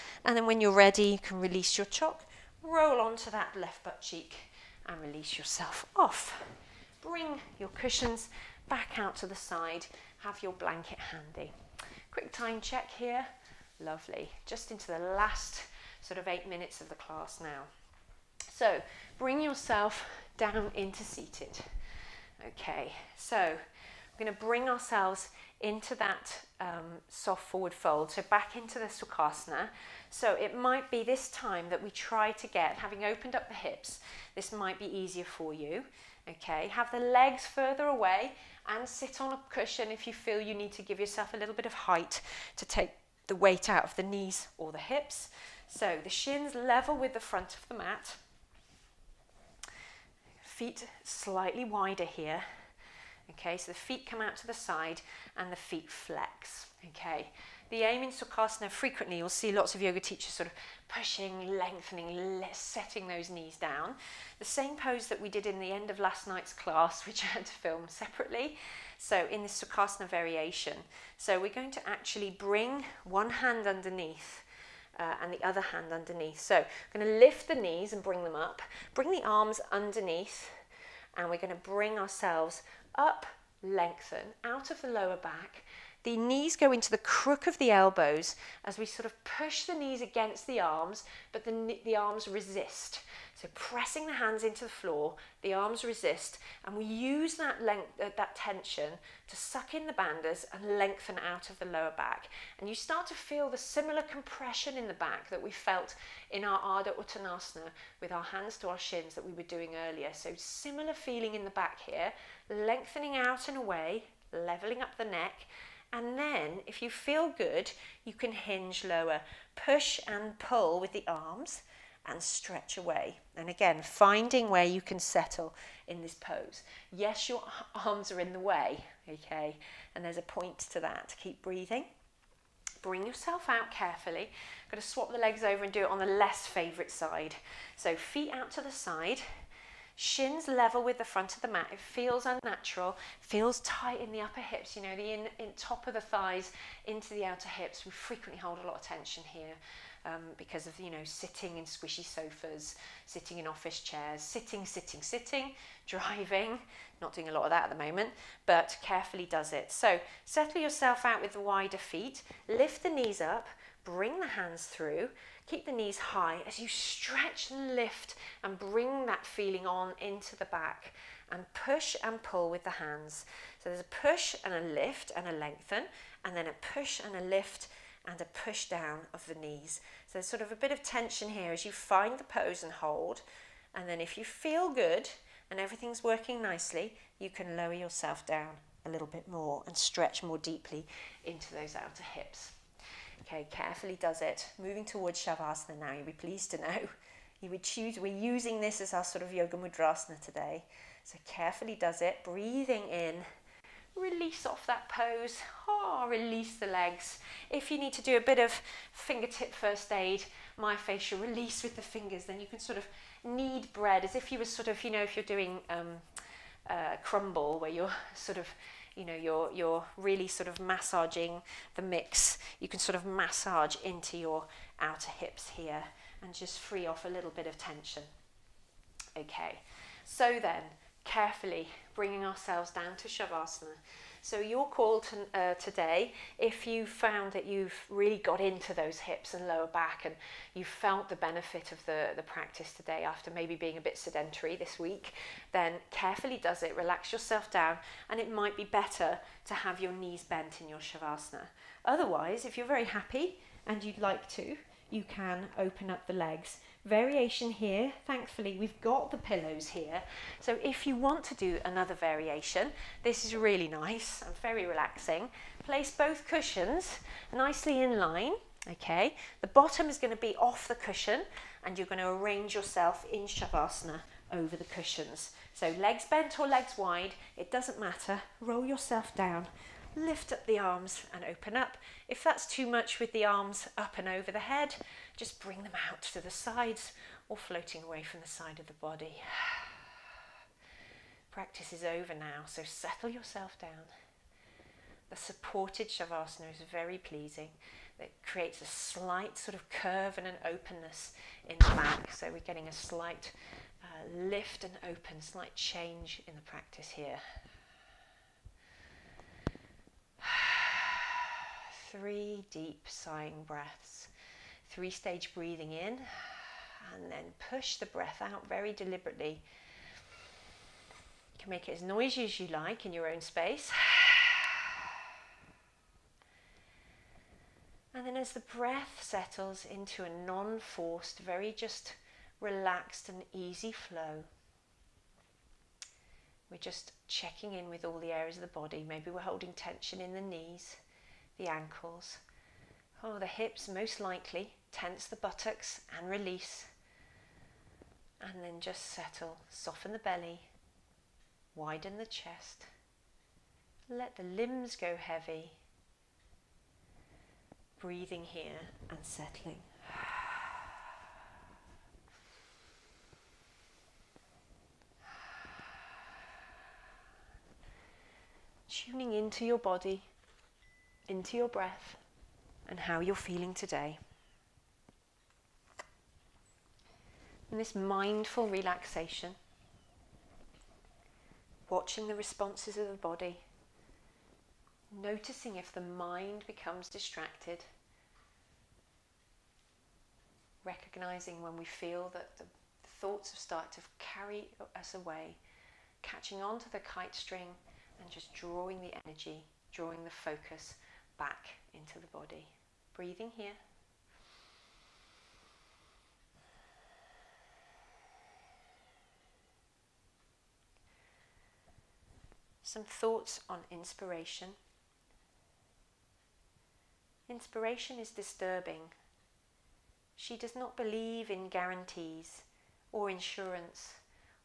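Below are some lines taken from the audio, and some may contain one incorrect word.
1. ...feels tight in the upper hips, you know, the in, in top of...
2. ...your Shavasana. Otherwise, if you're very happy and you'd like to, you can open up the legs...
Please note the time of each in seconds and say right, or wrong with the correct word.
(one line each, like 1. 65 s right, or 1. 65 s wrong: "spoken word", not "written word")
1. 143 s right
2. 250 s right.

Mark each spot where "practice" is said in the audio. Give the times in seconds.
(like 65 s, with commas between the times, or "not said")
242 s, 291 s, 306 s.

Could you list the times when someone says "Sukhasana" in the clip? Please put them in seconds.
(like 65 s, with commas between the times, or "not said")
28 s, 58 s, 69 s.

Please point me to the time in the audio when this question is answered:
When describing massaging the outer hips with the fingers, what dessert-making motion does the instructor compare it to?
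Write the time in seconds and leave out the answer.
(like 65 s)
217 s.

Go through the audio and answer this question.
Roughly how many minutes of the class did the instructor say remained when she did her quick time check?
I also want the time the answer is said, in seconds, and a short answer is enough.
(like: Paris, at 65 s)
8, at 16 s.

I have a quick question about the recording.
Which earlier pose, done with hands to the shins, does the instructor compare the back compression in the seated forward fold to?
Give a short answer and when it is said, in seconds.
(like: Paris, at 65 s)
Ardha Uttanasana, at 106 s.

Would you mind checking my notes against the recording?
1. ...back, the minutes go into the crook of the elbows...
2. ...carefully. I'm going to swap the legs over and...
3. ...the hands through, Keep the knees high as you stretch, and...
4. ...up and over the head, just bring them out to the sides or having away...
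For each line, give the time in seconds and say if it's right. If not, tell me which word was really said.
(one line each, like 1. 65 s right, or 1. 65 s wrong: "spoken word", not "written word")
1. 85 s wrong: "knees", not "minutes"
2. 133 s right
3. 164 s right
4. 283 s wrong: "floating", not "having".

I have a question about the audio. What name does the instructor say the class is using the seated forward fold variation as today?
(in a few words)
Yoga Mudrasana.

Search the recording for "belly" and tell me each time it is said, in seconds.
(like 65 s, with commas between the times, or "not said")
349 s.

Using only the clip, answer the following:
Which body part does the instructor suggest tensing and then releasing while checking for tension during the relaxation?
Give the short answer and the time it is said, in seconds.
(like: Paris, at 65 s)
Buttocks, at 345 s.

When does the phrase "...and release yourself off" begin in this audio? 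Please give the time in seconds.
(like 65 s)
4 s.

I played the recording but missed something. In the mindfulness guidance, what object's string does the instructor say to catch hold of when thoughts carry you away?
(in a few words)
Kite.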